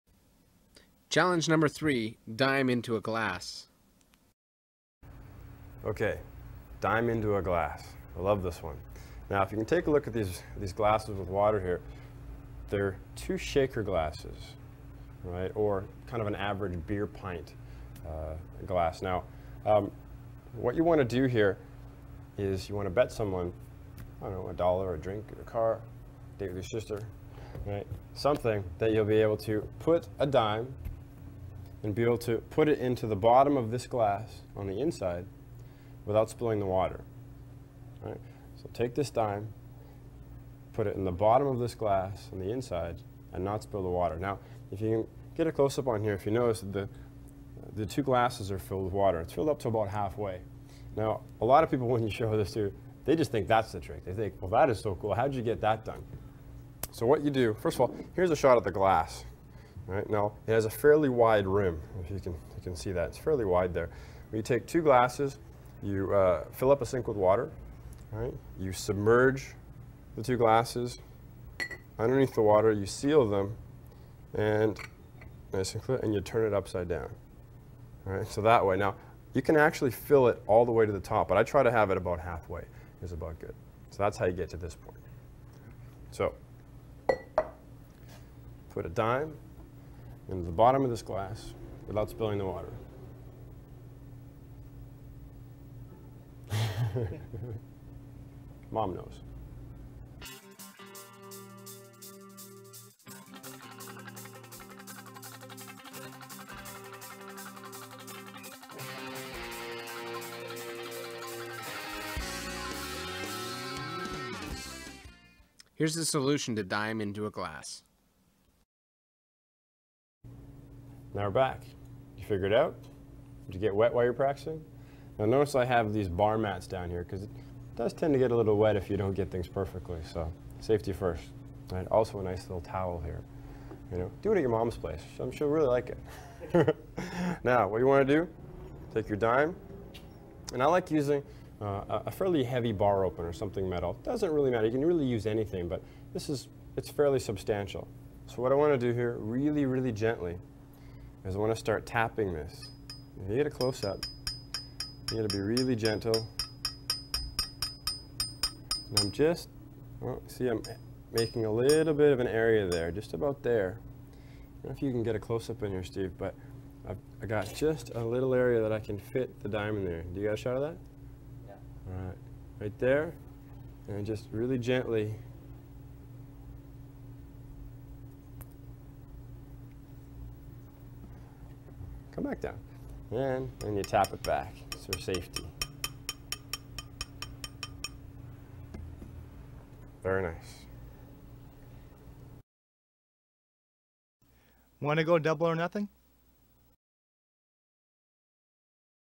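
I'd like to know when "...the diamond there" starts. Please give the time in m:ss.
2:49.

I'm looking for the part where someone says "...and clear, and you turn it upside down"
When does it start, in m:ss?
1:15.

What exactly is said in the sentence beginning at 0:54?
They think, well, that is so cool.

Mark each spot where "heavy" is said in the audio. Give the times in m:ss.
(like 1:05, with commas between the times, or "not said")
2:22.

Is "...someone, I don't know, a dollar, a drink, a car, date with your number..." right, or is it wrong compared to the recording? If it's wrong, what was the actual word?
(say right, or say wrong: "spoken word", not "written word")
wrong: "sister", not "number".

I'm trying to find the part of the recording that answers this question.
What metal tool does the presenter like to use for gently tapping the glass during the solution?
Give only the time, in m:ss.
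2:22.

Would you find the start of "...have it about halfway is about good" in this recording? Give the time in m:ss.
1:21.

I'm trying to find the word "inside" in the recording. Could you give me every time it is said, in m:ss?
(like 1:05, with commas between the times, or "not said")
0:34, 0:42.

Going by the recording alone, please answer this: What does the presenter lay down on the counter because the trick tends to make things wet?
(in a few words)
bar mats.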